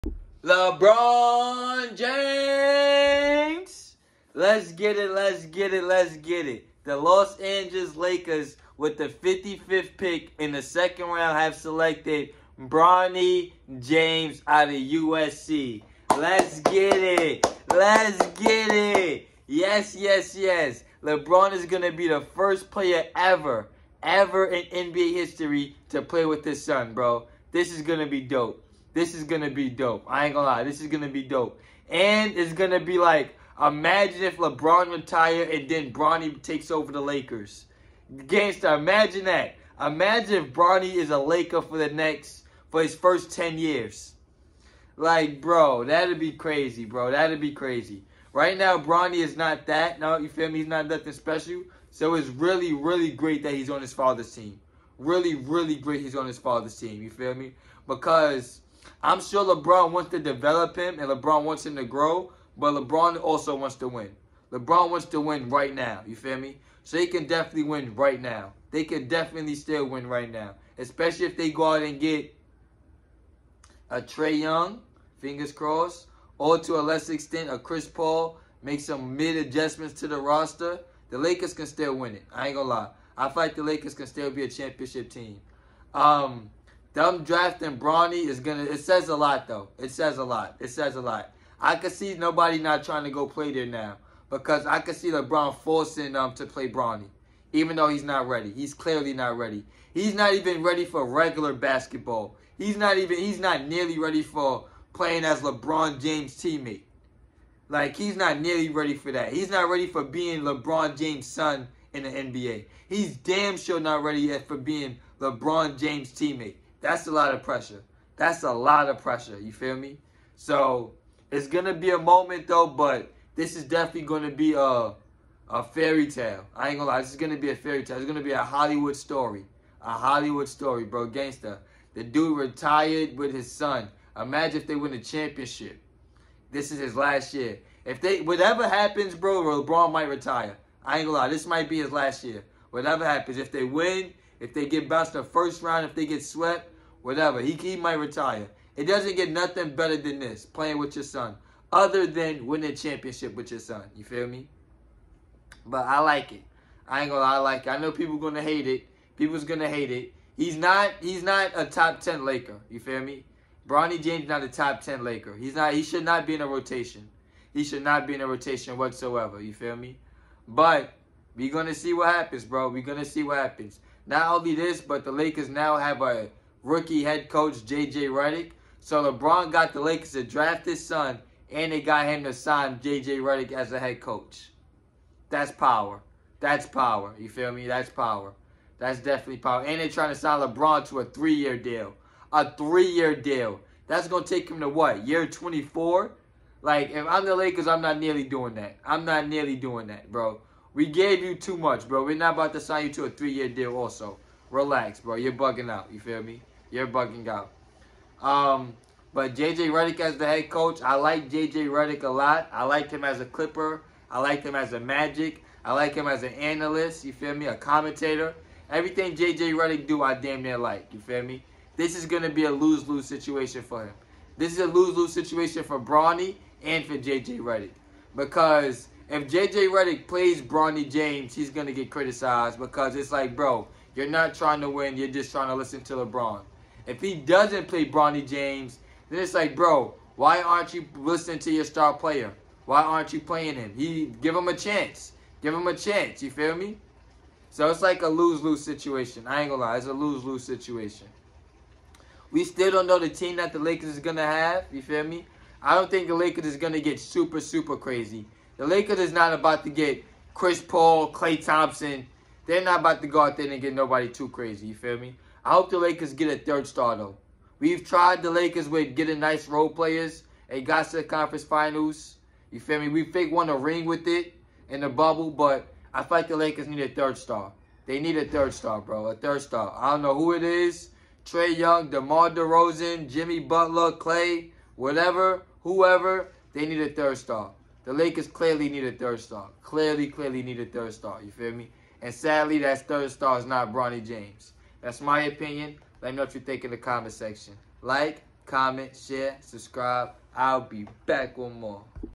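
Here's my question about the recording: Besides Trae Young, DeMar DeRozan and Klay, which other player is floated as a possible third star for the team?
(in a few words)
Jimmy Butler.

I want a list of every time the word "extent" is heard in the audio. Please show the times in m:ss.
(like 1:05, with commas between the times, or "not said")
1:17.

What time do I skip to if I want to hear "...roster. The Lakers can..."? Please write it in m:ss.
1:20.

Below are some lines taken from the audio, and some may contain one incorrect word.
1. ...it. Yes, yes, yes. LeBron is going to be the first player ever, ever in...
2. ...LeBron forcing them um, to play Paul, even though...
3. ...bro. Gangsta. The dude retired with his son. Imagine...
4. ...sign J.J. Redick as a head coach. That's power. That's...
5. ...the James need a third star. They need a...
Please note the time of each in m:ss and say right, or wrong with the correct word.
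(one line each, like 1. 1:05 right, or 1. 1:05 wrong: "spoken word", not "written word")
1. 0:18 right
2. 1:35 wrong: "Bronny", not "Paul"
3. 2:10 right
4. 3:02 right
5. 4:36 wrong: "Lakers", not "James".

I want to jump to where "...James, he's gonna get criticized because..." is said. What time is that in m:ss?
3:50.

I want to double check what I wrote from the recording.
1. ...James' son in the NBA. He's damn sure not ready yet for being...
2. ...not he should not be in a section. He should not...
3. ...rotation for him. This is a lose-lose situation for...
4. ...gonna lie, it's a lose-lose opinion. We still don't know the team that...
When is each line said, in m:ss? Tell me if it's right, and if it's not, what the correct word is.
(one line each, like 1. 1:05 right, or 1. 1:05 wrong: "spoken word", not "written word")
1. 1:50 right
2. 2:45 wrong: "rotation", not "section"
3. 3:43 wrong: "situation", not "rotation"
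4. 4:09 wrong: "situation", not "opinion".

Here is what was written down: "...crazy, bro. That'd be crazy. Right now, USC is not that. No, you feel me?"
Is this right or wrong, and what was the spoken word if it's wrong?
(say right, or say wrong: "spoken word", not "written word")
wrong: "Bronny", not "USC".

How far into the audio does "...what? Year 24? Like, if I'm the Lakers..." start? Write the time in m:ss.
3:14.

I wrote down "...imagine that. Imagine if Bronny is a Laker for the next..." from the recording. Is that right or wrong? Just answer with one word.
right.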